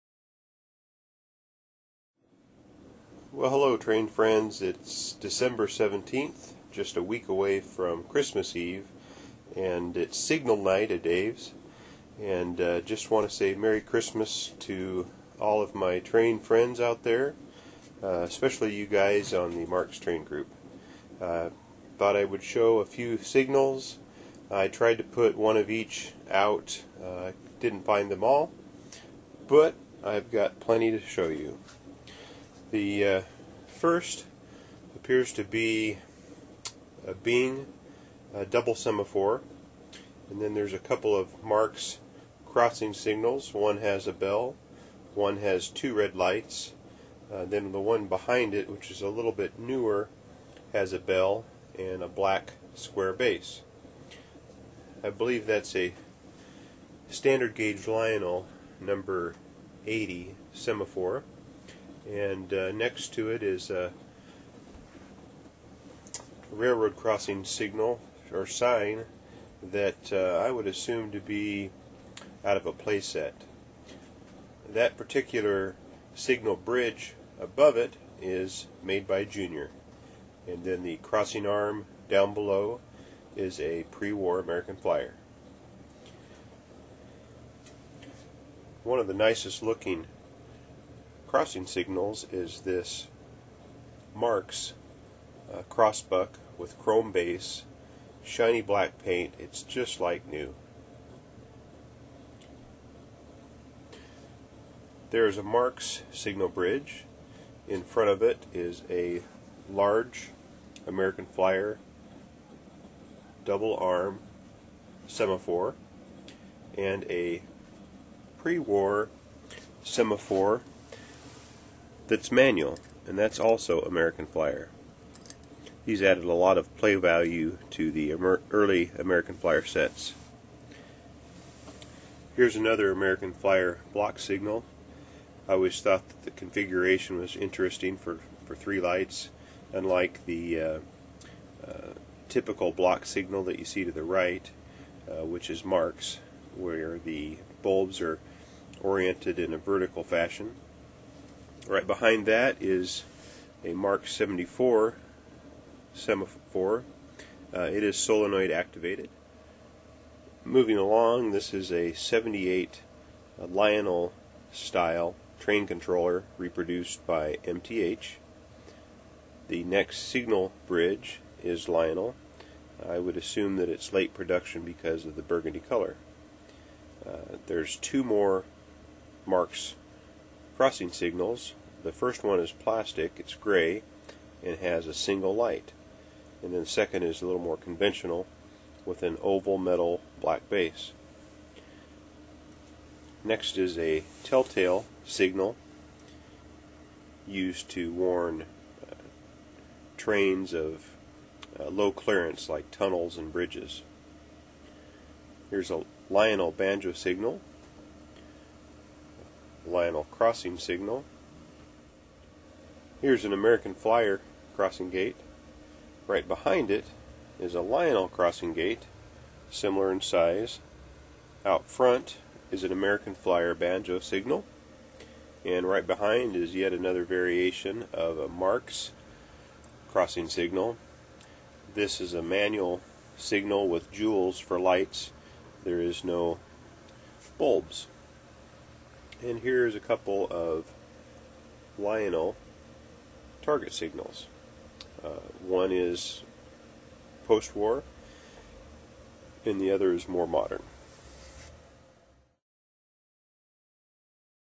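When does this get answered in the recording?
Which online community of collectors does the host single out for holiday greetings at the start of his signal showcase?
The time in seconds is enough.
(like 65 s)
19 s.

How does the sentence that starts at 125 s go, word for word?
These added a lot of play value to the early American Flyer sets.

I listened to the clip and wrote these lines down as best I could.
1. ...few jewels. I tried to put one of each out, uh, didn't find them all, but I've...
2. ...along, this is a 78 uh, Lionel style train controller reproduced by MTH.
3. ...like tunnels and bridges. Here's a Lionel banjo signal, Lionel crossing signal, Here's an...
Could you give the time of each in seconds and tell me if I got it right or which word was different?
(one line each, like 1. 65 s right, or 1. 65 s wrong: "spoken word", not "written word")
1. 22 s wrong: "signals", not "jewels"
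2. 160 s right
3. 202 s right.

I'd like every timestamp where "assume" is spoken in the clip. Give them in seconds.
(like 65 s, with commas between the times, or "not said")
70 s, 173 s.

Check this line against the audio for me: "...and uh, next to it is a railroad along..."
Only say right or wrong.
wrong.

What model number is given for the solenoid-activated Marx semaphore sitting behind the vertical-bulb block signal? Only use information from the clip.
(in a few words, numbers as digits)
74.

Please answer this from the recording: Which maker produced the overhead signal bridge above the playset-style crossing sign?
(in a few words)
Junior.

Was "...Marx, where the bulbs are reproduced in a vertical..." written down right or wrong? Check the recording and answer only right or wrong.
wrong.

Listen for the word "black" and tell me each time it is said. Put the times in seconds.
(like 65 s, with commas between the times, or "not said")
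52 s, 98 s, 190 s.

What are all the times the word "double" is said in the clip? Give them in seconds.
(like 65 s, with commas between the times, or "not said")
38 s, 113 s.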